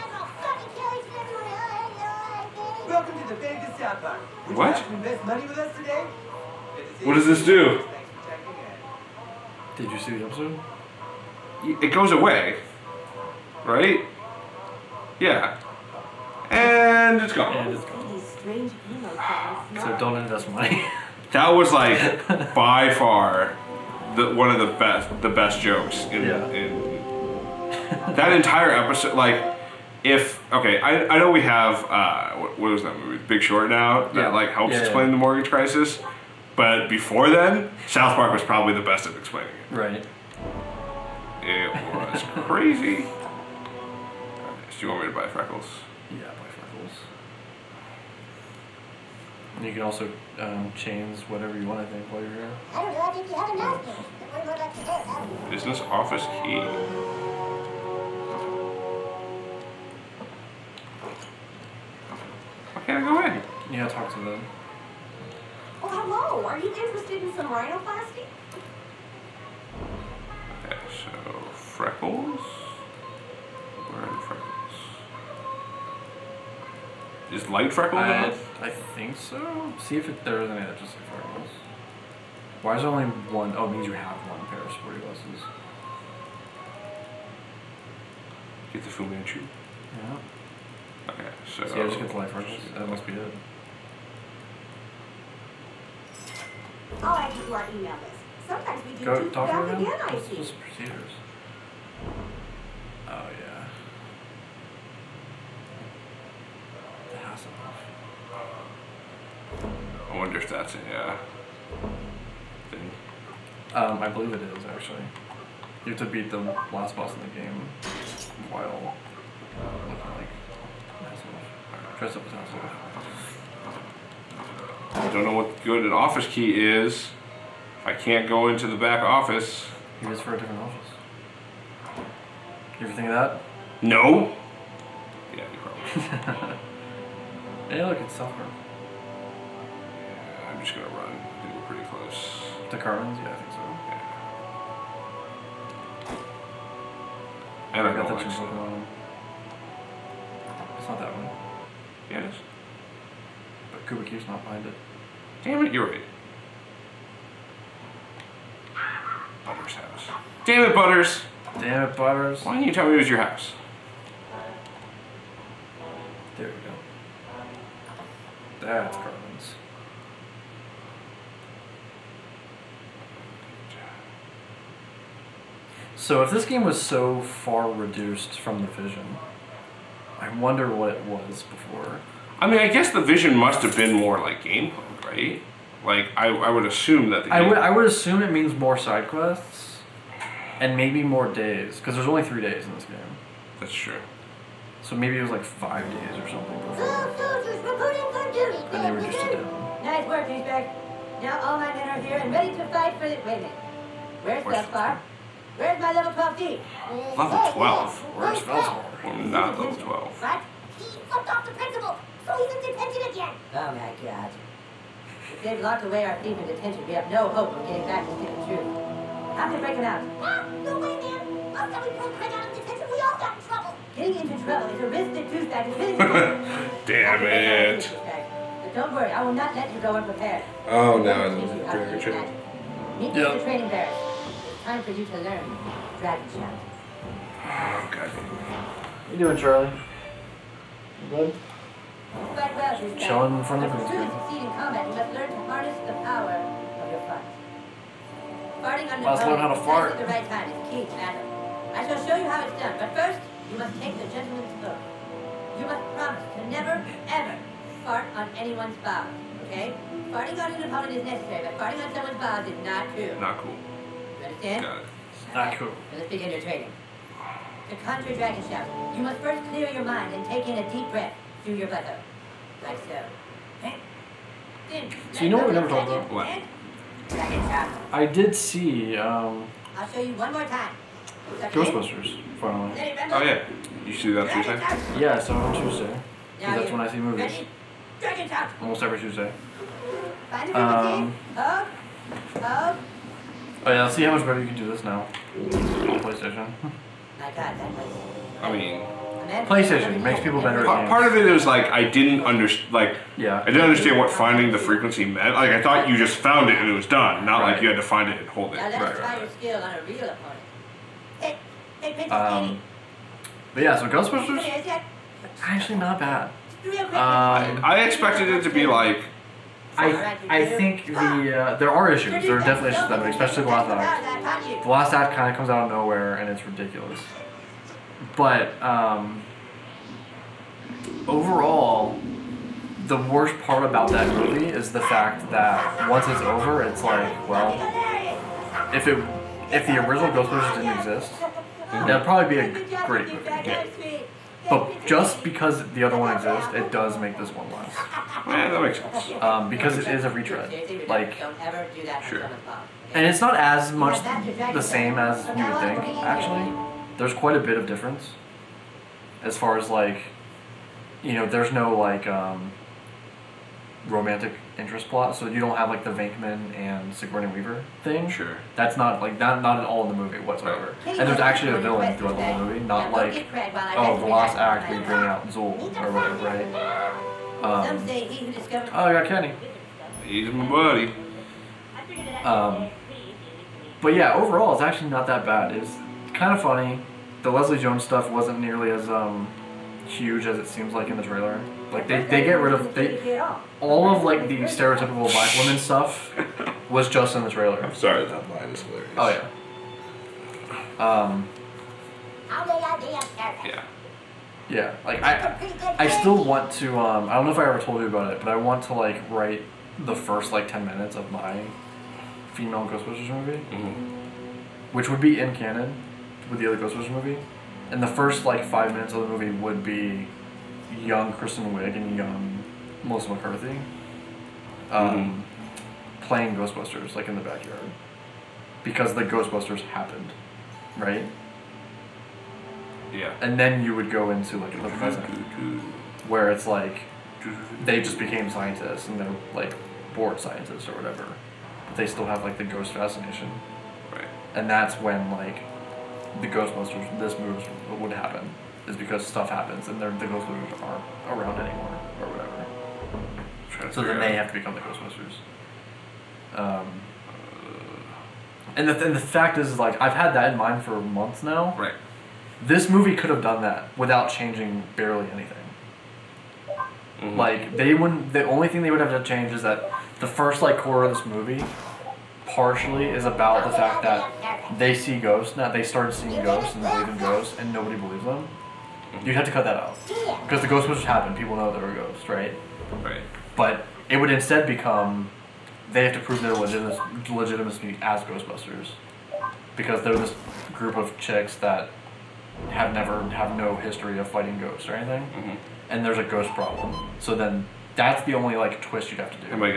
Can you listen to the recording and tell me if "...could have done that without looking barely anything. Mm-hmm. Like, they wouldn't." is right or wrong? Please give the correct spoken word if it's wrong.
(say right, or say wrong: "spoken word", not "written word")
wrong: "changing", not "looking".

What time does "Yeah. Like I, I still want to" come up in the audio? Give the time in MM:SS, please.
06:44.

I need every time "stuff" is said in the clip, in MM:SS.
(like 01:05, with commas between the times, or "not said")
06:27, 06:35, 07:29.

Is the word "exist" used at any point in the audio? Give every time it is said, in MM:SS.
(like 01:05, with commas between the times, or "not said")
05:40, 05:46.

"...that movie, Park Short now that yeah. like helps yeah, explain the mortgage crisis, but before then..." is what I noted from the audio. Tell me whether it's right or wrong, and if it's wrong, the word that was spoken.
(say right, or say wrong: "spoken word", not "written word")
wrong: "Big", not "Park".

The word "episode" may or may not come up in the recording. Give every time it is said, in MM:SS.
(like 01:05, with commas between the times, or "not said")
00:10, 00:28.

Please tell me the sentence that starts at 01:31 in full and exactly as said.
See, I just get the light freckles.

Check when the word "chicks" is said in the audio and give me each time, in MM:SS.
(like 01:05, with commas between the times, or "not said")
08:10.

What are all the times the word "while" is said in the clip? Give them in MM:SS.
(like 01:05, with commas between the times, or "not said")
00:52, 01:58.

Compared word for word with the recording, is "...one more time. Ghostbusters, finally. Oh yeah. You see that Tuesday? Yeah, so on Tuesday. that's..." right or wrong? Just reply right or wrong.
right.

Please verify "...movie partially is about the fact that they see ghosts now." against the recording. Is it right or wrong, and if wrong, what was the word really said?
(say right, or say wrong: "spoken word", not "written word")
right.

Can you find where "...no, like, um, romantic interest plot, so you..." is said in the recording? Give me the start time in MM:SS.
06:01.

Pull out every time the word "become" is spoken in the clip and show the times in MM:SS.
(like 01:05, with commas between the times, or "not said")
07:34, 08:04.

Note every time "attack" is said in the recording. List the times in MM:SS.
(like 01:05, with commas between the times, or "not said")
not said.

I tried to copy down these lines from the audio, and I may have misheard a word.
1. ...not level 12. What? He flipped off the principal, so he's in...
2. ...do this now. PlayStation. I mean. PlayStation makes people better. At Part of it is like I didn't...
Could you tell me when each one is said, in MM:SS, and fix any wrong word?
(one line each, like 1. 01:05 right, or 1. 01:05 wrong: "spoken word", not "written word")
1. 03:29 right
2. 04:54 right.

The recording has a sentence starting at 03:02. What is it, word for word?
I mean, I guess the vision must have been more like game mode, right?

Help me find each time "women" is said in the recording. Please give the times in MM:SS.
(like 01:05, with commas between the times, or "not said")
06:35.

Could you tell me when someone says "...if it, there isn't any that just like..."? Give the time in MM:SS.
01:19.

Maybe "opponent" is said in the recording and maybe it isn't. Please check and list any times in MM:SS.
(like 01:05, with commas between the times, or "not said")
04:20, 05:10.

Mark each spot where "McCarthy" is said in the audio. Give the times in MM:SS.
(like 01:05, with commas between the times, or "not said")
07:03.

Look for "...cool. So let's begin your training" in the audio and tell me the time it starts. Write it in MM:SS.
04:25.